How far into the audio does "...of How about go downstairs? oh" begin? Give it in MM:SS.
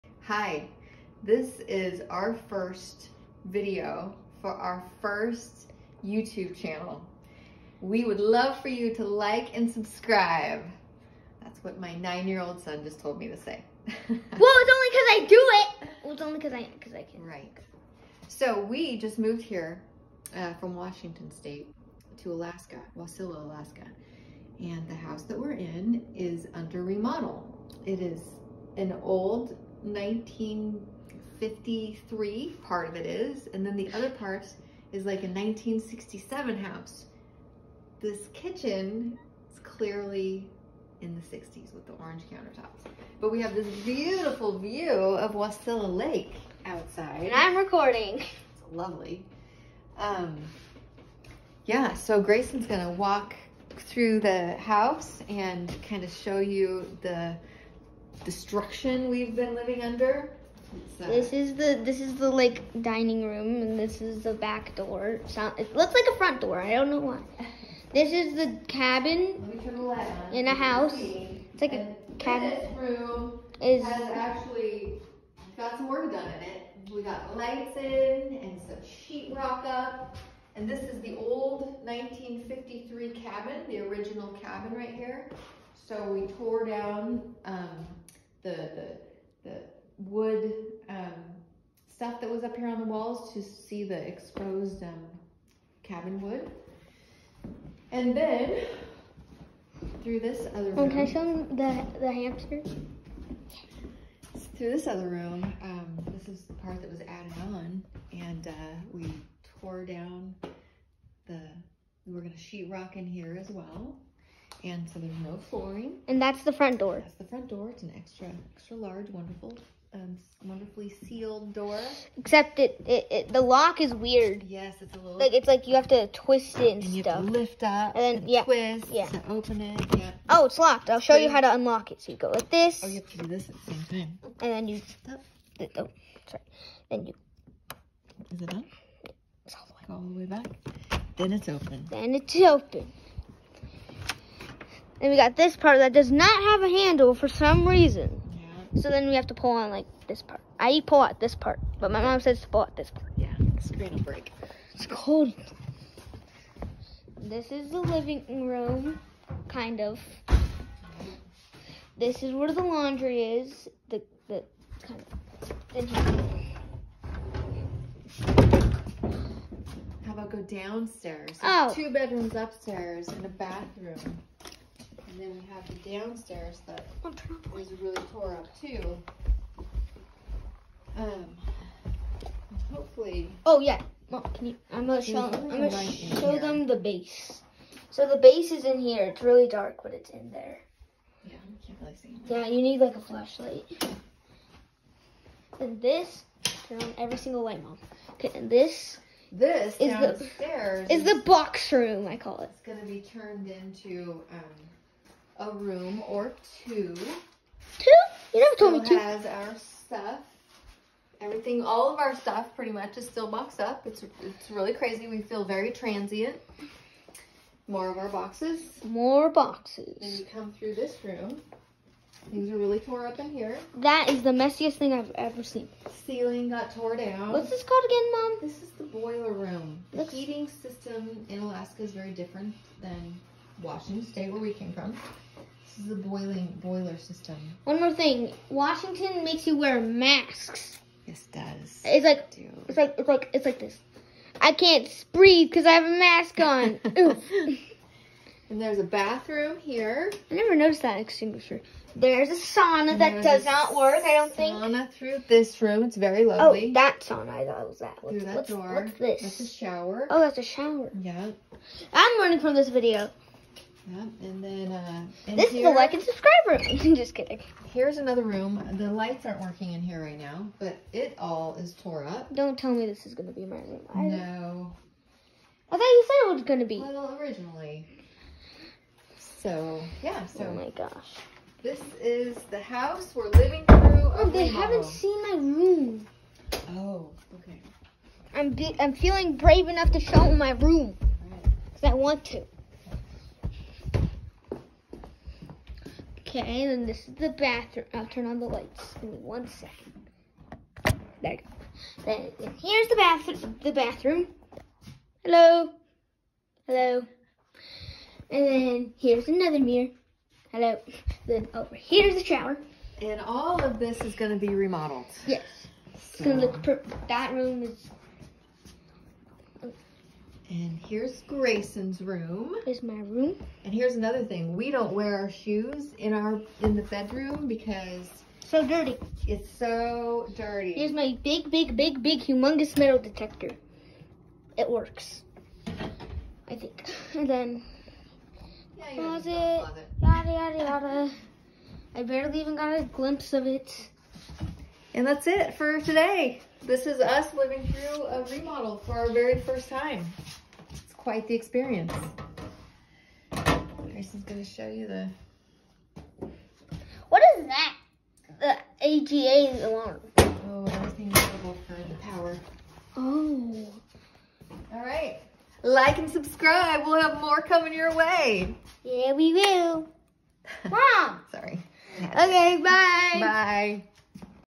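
02:45.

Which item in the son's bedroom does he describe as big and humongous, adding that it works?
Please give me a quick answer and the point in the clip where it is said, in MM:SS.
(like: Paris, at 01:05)
Metal detector, at 05:32.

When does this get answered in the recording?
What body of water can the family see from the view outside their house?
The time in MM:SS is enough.
00:45.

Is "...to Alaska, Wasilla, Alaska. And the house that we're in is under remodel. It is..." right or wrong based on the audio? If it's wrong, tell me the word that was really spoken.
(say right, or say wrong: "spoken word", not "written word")
right.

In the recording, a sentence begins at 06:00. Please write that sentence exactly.
Oh, everything's available for the power.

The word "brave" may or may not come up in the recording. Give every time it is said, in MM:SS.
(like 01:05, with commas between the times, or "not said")
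04:49.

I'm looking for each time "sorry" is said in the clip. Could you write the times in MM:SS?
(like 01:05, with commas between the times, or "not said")
02:16, 06:11.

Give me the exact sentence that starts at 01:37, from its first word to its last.
And then through this other room.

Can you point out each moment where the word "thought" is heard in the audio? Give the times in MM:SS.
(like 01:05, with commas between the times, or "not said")
04:17, 04:35.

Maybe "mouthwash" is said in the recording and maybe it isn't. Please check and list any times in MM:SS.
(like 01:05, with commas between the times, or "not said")
not said.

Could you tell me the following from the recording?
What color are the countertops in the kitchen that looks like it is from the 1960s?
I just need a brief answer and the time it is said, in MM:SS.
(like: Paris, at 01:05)
Orange, at 00:41.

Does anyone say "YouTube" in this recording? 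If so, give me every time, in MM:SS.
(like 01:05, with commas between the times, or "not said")
00:06.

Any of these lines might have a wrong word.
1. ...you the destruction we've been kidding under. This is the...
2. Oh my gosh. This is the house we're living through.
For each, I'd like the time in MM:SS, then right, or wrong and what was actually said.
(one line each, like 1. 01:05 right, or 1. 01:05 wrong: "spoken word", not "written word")
1. 00:56 wrong: "living", not "kidding"
2. 04:40 right.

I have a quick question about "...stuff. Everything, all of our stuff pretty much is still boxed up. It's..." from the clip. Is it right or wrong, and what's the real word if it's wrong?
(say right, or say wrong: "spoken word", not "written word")
right.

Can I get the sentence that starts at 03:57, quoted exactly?
One more thing, Washington makes you wear masks.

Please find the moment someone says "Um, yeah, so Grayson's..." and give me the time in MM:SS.
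00:49.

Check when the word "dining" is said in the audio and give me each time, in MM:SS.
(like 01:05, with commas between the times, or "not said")
01:02.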